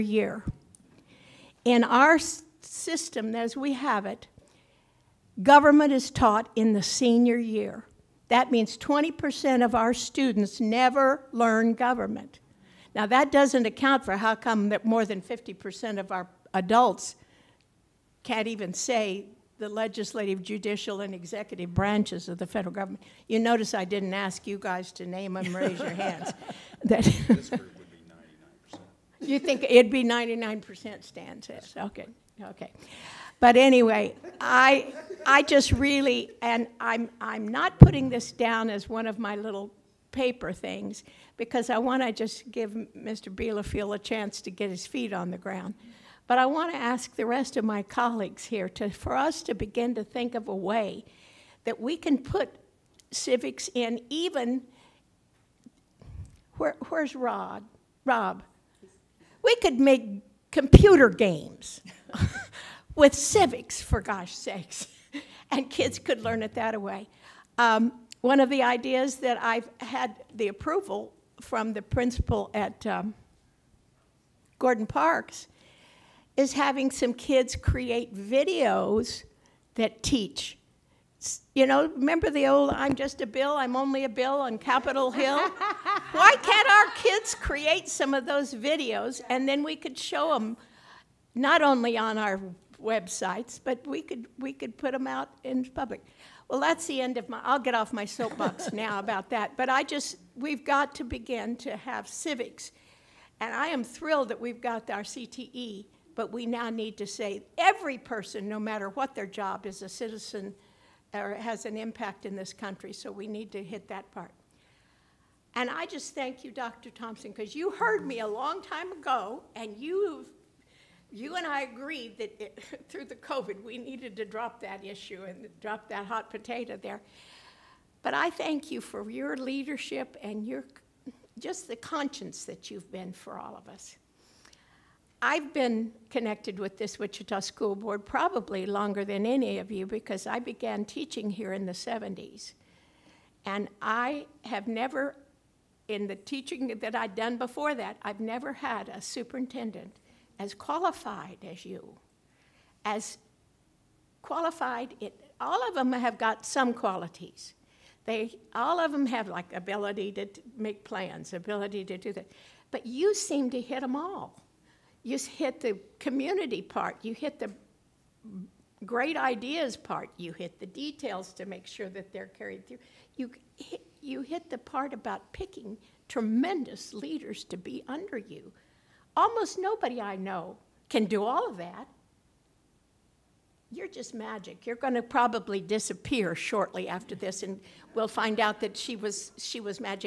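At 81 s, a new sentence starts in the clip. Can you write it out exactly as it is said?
You know, remember the old I'm just a bill, I'm only a bill on Capitol Hill?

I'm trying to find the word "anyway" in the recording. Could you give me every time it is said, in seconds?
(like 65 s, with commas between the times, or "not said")
33 s.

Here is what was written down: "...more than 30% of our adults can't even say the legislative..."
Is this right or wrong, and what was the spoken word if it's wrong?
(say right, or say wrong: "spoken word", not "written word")
wrong: "50", not "30".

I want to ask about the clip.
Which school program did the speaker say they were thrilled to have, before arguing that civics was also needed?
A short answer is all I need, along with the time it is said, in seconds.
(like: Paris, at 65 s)
CTE, at 105 s.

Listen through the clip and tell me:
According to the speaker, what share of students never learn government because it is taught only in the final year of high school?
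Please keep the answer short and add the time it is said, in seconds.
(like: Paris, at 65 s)
20%, at 8 s.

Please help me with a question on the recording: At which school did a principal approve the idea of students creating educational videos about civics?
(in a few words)
Gordon Parks.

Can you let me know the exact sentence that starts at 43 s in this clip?
Bielefeld a chance to get his feet on the ground.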